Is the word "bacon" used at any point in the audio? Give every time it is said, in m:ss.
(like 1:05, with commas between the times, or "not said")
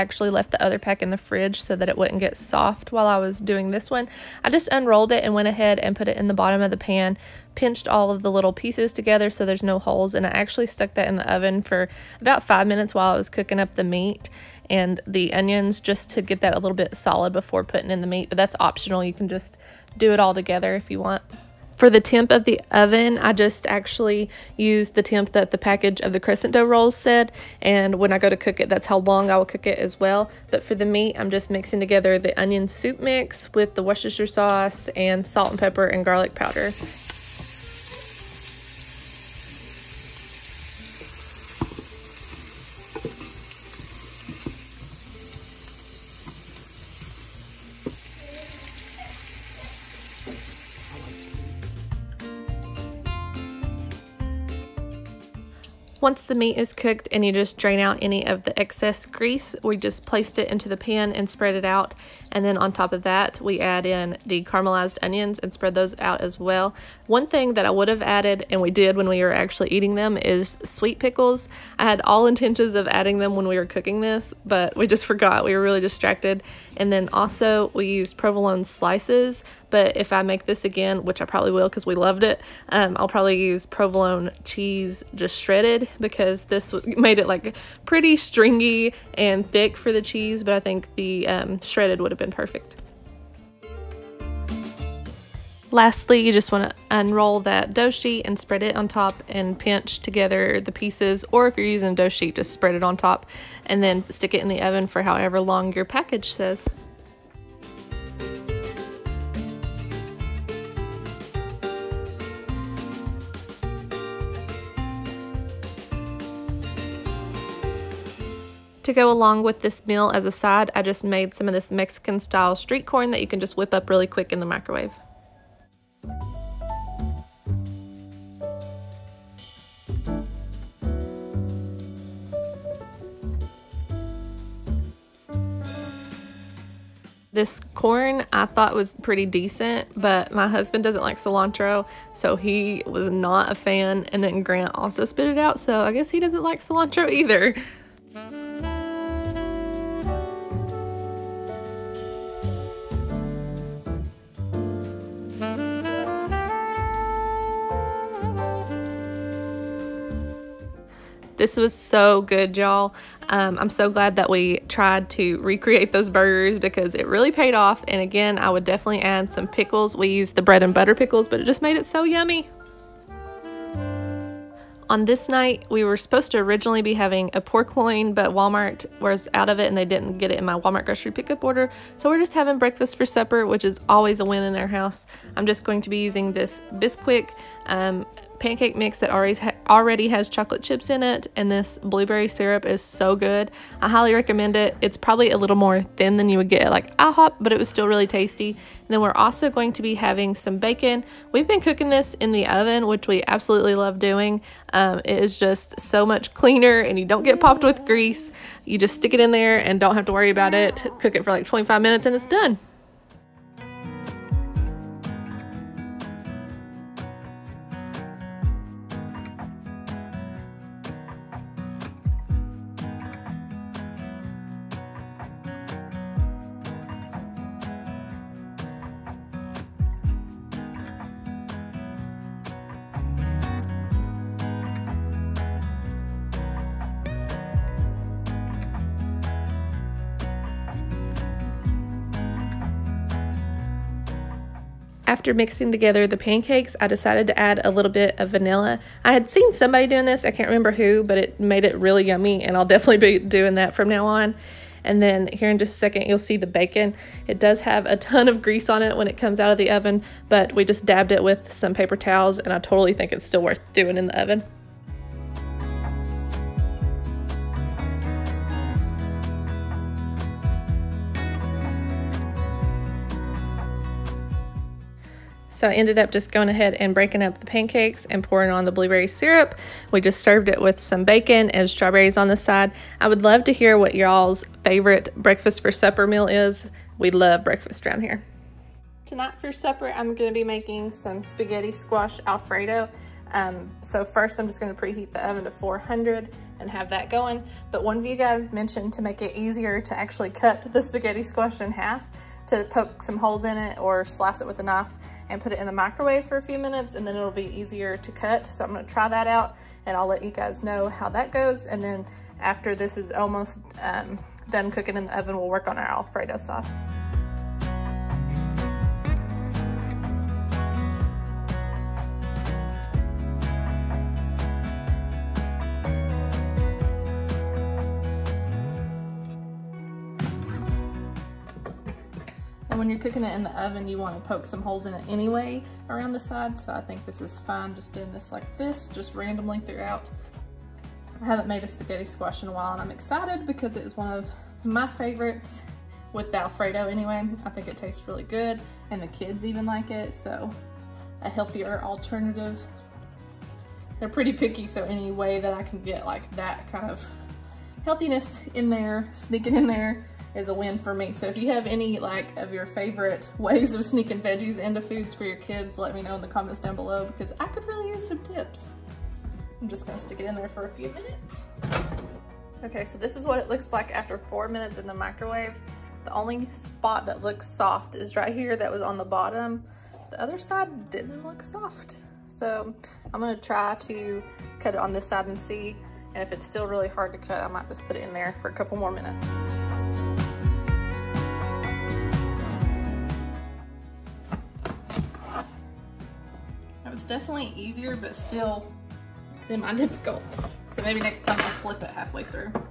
3:20, 4:16, 4:41.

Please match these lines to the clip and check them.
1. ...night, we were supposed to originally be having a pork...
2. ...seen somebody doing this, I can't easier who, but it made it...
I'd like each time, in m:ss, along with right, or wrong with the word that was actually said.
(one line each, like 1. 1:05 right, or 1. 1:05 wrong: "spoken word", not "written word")
1. 2:55 right
2. 4:09 wrong: "remember", not "easier".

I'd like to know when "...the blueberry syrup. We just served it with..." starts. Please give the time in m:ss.
4:38.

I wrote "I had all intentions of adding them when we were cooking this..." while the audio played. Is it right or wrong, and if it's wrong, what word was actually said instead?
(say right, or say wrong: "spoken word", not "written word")
right.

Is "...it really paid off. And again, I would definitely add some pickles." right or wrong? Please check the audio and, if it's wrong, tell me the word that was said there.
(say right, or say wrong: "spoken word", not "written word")
right.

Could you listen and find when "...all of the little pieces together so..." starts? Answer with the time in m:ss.
0:07.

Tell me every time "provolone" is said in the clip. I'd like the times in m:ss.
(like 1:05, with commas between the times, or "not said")
1:18, 1:23.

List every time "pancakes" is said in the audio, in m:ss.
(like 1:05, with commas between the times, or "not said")
3:08, 4:06, 4:37.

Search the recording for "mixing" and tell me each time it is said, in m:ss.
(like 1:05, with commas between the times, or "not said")
0:31, 4:05.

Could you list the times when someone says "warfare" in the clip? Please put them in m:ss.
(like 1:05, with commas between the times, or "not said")
not said.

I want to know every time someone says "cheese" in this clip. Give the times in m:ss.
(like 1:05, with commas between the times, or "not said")
1:24, 1:30.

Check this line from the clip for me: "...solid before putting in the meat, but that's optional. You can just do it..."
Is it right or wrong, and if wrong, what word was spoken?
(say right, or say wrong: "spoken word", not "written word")
right.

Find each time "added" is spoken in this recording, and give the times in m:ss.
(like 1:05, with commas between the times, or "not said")
1:08.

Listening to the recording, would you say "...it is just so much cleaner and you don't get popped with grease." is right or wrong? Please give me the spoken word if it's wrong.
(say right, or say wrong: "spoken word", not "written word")
right.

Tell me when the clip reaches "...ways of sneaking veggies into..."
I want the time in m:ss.
6:03.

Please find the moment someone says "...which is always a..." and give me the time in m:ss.
3:03.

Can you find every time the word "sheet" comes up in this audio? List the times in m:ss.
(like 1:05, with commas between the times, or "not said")
1:37, 1:42.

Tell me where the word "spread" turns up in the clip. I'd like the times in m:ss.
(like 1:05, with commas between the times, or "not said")
1:01, 1:05, 1:38, 1:42.